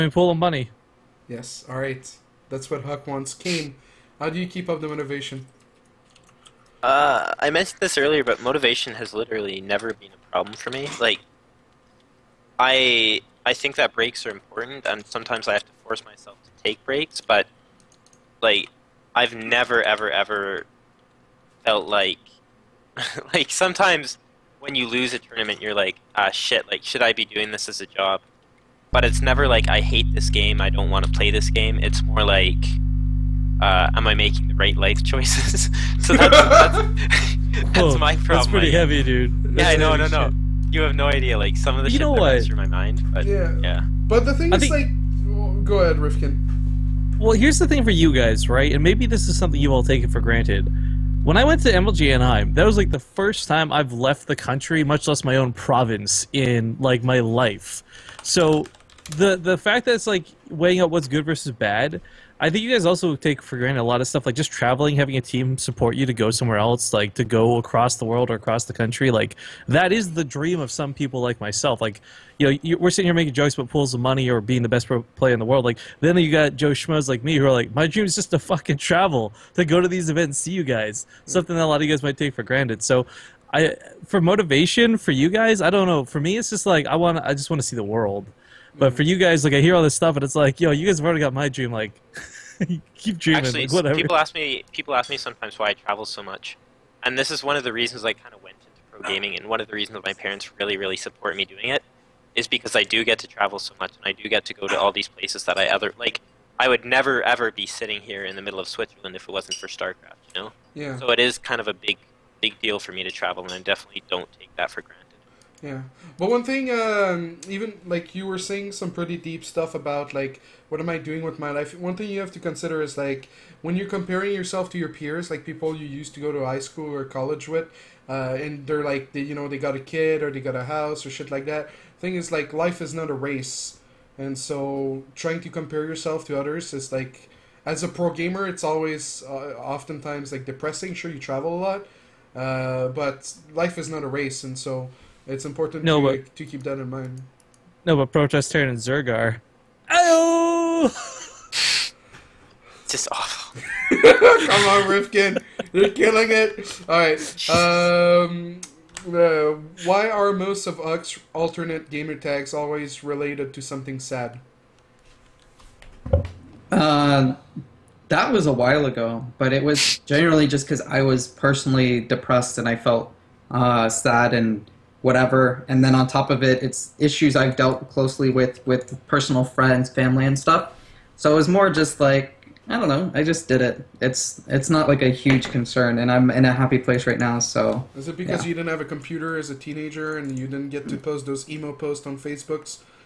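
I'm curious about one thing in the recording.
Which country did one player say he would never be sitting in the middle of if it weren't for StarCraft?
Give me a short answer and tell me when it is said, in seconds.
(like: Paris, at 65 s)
Switzerland, at 108 s.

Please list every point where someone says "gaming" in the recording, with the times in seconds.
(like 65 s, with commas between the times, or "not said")
99 s.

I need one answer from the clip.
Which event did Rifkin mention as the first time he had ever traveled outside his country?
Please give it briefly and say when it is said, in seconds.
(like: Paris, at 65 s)
MLG Anaheim, at 51 s.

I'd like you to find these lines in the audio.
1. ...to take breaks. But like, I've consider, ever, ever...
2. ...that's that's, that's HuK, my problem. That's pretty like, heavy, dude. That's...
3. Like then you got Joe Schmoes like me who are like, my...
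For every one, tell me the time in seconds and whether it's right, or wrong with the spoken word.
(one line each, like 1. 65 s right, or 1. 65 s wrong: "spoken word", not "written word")
1. 16 s wrong: "never", not "consider"
2. 36 s wrong: "Whoa", not "HuK"
3. 75 s right.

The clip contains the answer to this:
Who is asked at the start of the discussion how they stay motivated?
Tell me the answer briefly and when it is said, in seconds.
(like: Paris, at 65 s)
Kane, at 3 s.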